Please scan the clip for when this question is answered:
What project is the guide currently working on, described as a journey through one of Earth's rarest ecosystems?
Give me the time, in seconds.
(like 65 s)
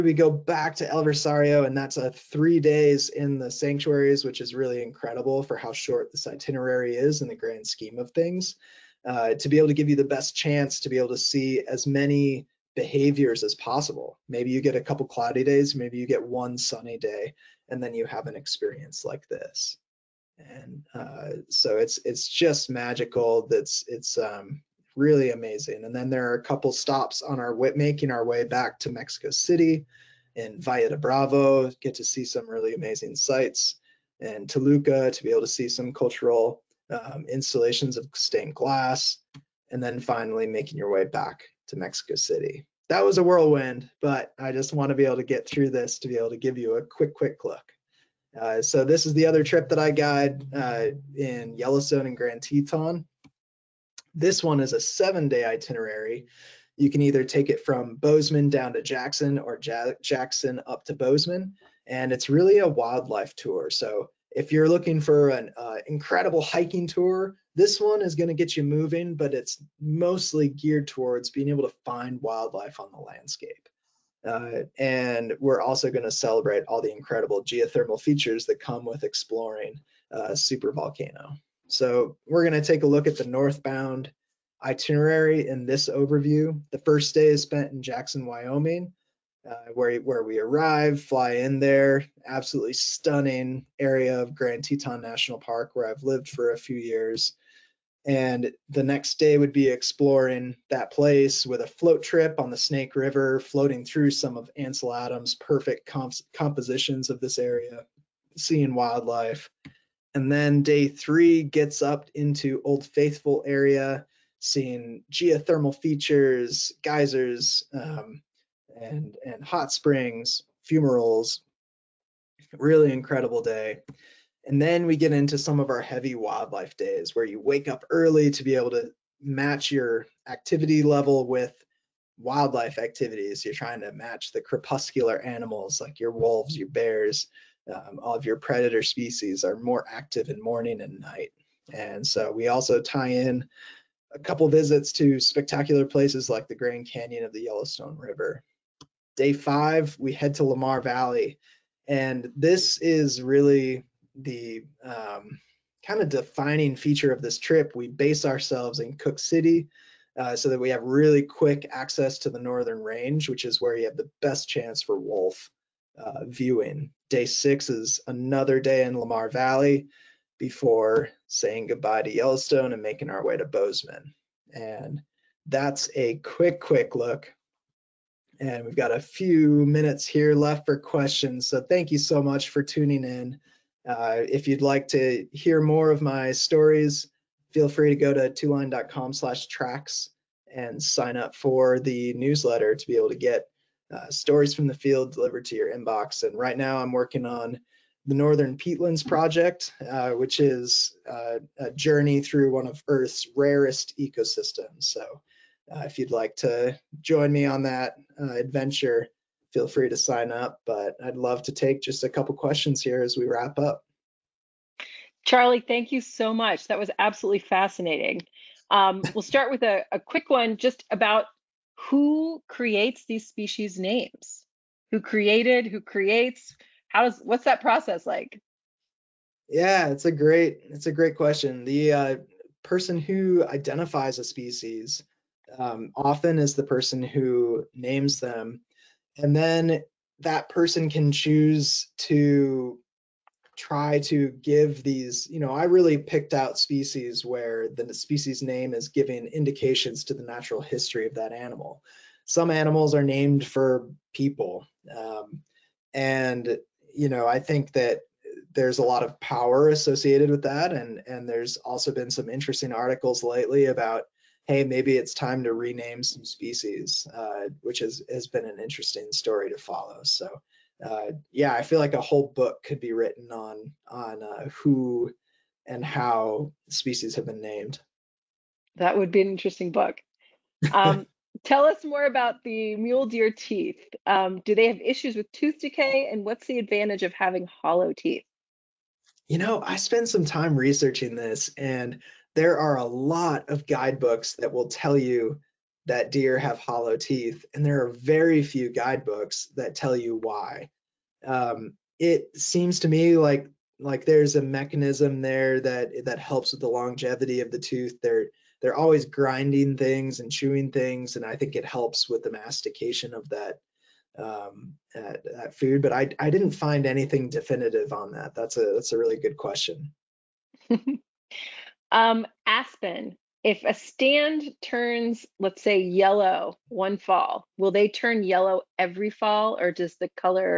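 198 s.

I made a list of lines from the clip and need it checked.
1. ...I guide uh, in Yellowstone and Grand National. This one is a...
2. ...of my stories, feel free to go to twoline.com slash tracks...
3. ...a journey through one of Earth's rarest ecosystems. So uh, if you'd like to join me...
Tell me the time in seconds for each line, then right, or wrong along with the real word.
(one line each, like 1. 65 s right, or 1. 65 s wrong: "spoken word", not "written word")
1. 49 s wrong: "Teton", not "National"
2. 185 s right
3. 201 s right.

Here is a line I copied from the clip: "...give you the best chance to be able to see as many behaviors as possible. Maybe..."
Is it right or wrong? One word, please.
right.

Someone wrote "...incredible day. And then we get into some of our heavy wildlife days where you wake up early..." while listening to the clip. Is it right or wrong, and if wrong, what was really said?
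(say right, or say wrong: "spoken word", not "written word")
right.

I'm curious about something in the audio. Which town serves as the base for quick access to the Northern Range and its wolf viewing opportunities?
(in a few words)
Cooke City.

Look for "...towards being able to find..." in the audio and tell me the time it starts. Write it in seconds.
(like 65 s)
70 s.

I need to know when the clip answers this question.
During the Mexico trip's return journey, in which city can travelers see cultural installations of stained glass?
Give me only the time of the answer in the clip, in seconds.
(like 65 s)
34 s.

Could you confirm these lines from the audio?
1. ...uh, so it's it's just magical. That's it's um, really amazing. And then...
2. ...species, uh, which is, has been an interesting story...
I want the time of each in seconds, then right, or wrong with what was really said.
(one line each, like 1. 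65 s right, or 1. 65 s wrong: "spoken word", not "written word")
1. 20 s right
2. 266 s right.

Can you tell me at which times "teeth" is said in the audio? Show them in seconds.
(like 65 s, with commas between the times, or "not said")
283 s, 287 s, 296 s.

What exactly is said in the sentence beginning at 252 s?
Some animals are named for people.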